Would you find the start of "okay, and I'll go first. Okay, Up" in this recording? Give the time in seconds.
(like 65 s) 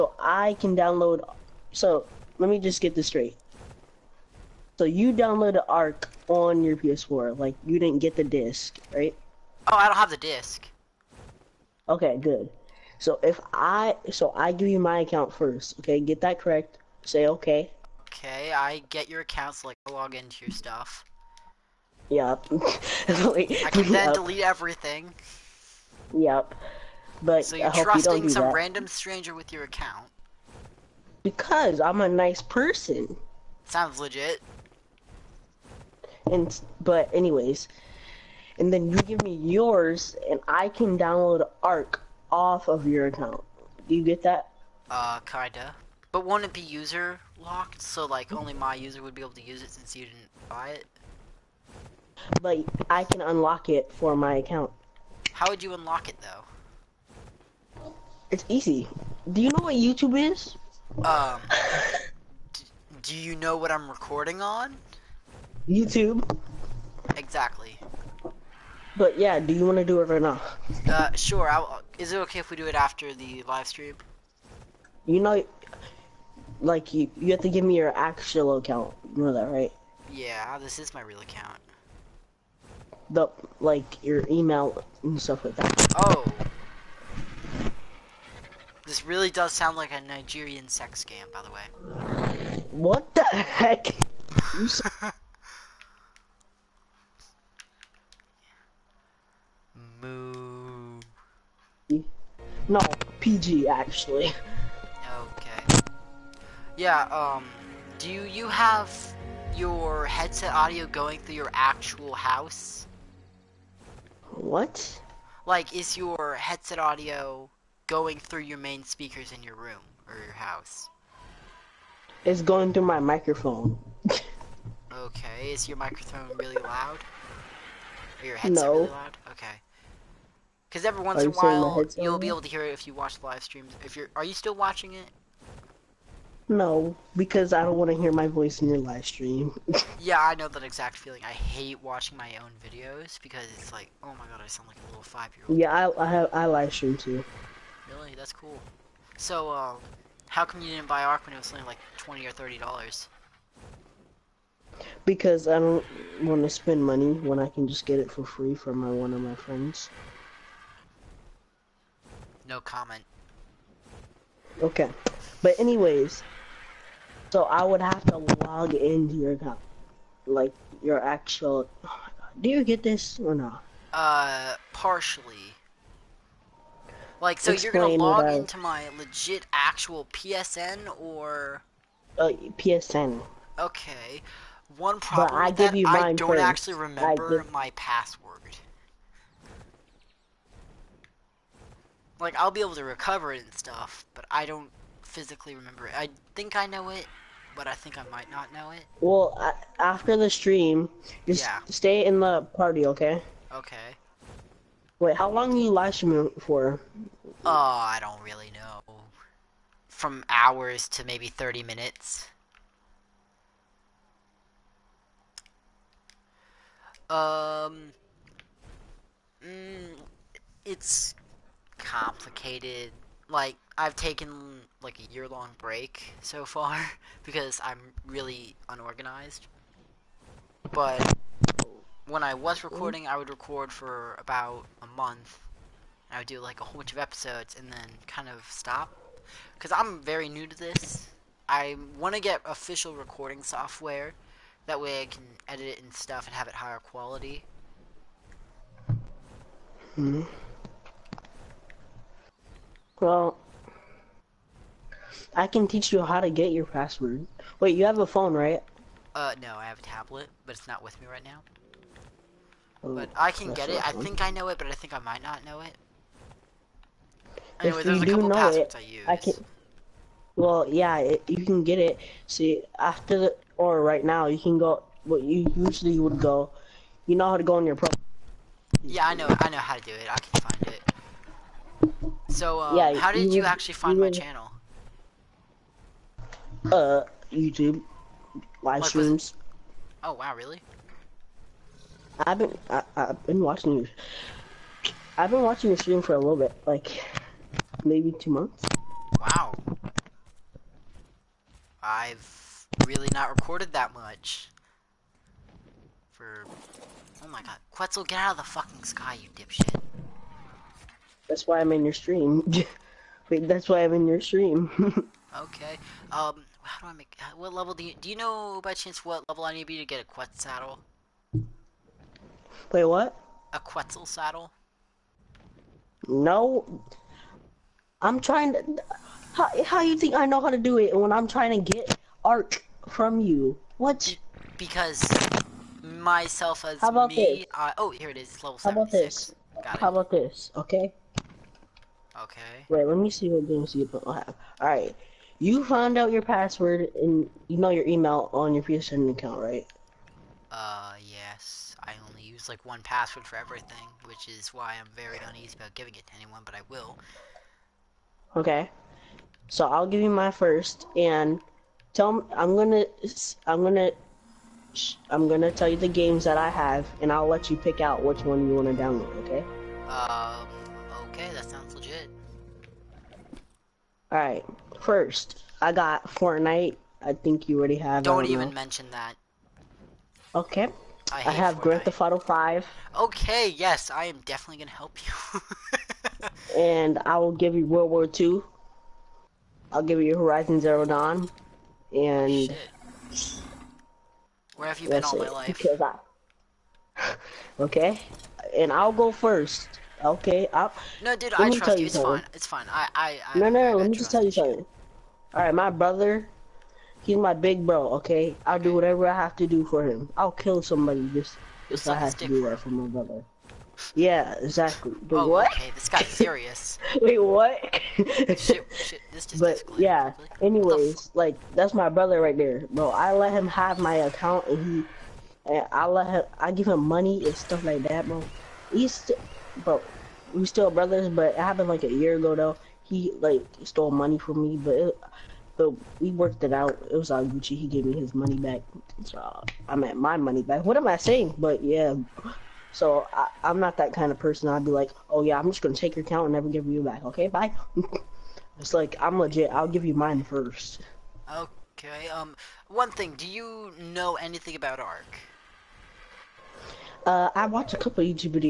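397 s.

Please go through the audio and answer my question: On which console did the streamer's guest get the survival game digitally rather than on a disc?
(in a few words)
PS4.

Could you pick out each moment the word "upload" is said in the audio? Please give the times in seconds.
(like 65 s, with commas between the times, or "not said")
not said.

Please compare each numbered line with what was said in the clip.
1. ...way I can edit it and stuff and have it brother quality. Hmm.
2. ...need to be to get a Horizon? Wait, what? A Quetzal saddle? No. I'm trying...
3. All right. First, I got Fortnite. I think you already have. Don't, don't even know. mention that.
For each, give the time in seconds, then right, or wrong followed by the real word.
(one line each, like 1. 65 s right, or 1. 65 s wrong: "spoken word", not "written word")
1. 244 s wrong: "higher", not "brother"
2. 319 s wrong: "Quetzal", not "Horizon"
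3. 374 s right.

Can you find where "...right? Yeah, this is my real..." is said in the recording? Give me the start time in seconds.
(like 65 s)
79 s.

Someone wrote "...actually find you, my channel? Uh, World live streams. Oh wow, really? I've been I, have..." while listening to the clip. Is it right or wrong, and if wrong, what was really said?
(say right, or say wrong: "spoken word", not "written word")
wrong: "YouTube", not "World".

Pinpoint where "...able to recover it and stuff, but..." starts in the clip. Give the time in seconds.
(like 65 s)
192 s.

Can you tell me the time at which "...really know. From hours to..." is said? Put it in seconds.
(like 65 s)
208 s.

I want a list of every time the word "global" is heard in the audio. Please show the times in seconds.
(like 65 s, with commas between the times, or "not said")
not said.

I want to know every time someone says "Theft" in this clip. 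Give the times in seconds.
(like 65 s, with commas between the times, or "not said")
381 s.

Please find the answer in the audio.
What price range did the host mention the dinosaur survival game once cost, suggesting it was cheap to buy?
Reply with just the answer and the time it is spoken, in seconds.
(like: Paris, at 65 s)
$20 or $30, at 151 s.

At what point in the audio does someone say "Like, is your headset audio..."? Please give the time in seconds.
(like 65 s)
115 s.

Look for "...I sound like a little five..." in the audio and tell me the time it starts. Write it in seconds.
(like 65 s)
144 s.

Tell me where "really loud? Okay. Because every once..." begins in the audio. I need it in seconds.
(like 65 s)
128 s.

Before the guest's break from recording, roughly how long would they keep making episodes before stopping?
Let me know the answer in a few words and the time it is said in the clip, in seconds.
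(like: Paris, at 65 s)
A month, at 234 s.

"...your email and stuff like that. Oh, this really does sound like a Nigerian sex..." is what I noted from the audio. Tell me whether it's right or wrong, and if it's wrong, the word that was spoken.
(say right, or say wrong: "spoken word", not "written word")
right.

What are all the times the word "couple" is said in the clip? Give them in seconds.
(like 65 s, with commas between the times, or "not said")
268 s, 457 s.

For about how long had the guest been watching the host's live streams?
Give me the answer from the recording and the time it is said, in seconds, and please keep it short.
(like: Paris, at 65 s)
2 months, at 298 s.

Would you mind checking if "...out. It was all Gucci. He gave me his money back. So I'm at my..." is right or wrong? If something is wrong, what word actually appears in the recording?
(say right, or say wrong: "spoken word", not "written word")
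right.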